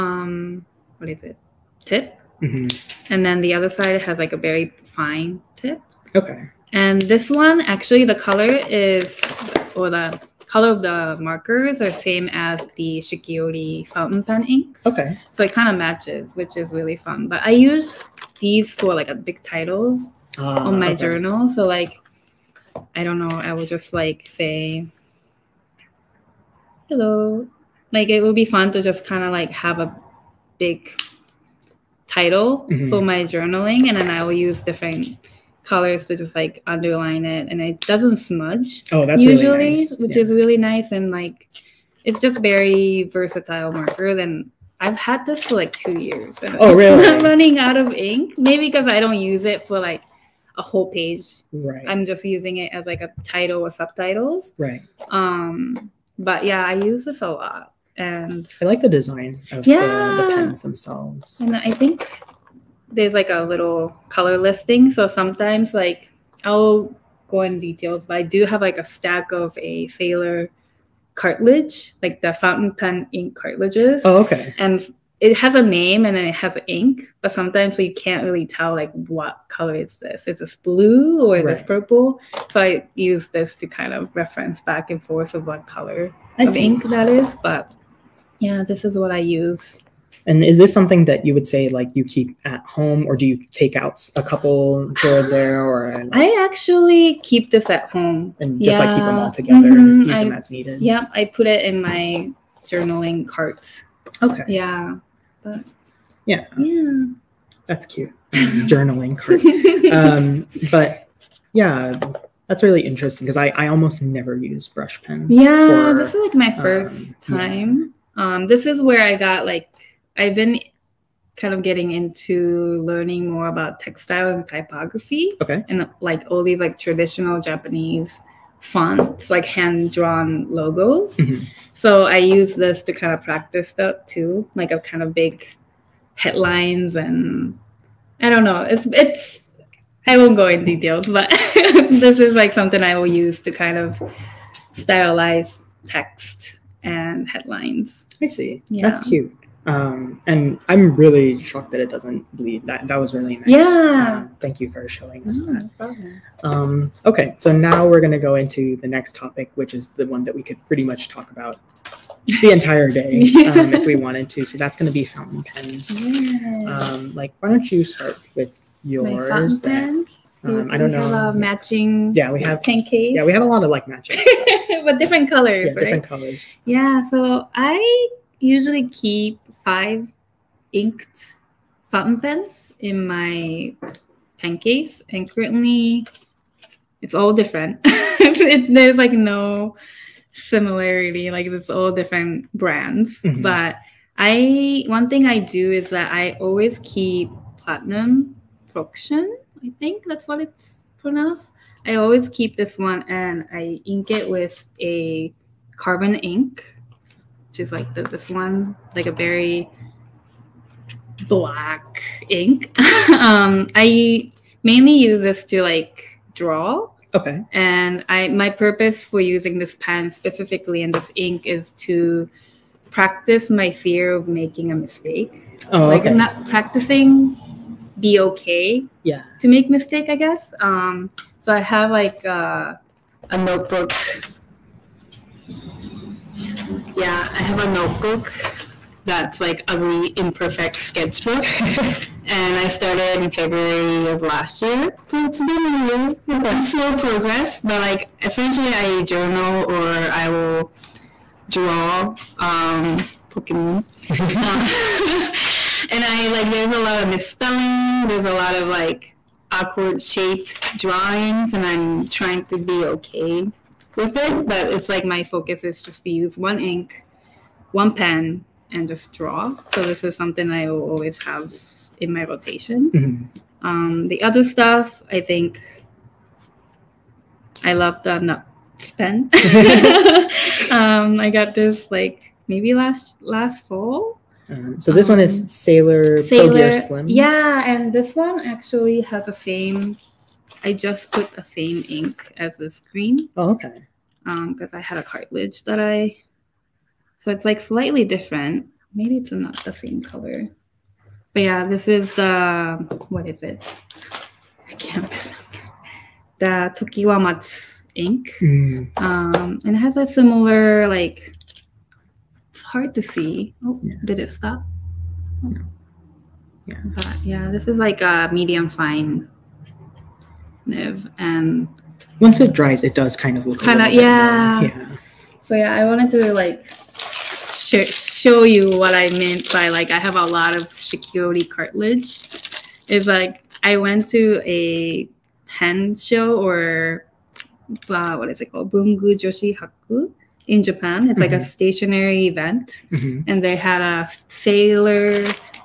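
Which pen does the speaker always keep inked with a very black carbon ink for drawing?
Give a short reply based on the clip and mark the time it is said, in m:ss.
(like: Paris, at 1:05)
Platinum Procyon, at 3:17.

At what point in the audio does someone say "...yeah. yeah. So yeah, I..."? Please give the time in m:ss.
5:23.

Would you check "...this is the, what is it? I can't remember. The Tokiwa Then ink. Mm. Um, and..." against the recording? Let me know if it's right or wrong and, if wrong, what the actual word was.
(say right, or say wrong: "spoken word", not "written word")
wrong: "Matsu", not "Then".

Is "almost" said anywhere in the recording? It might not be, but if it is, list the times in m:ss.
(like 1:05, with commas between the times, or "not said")
1:53.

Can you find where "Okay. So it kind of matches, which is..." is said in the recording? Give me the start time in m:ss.
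0:14.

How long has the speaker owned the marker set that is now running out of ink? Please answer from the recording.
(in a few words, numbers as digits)
2 years.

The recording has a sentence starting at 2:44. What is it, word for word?
So that's gonna be fountain pens.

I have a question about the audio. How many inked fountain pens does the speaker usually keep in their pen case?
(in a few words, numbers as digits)
5.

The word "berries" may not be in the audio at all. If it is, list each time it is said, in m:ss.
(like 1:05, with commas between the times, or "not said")
not said.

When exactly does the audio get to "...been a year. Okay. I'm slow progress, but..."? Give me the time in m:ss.
4:05.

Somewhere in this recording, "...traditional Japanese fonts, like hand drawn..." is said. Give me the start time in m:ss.
2:06.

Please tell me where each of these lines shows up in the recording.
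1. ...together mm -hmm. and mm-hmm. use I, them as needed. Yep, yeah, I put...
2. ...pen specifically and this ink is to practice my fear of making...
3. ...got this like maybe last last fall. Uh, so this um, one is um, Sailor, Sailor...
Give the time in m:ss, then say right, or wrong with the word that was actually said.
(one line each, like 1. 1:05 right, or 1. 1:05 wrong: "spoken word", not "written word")
1. 1:39 right
2. 3:39 right
3. 4:41 right.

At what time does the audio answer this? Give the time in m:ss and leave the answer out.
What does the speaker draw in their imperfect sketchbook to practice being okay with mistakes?
4:13.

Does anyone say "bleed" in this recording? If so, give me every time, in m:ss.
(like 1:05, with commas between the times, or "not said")
2:32.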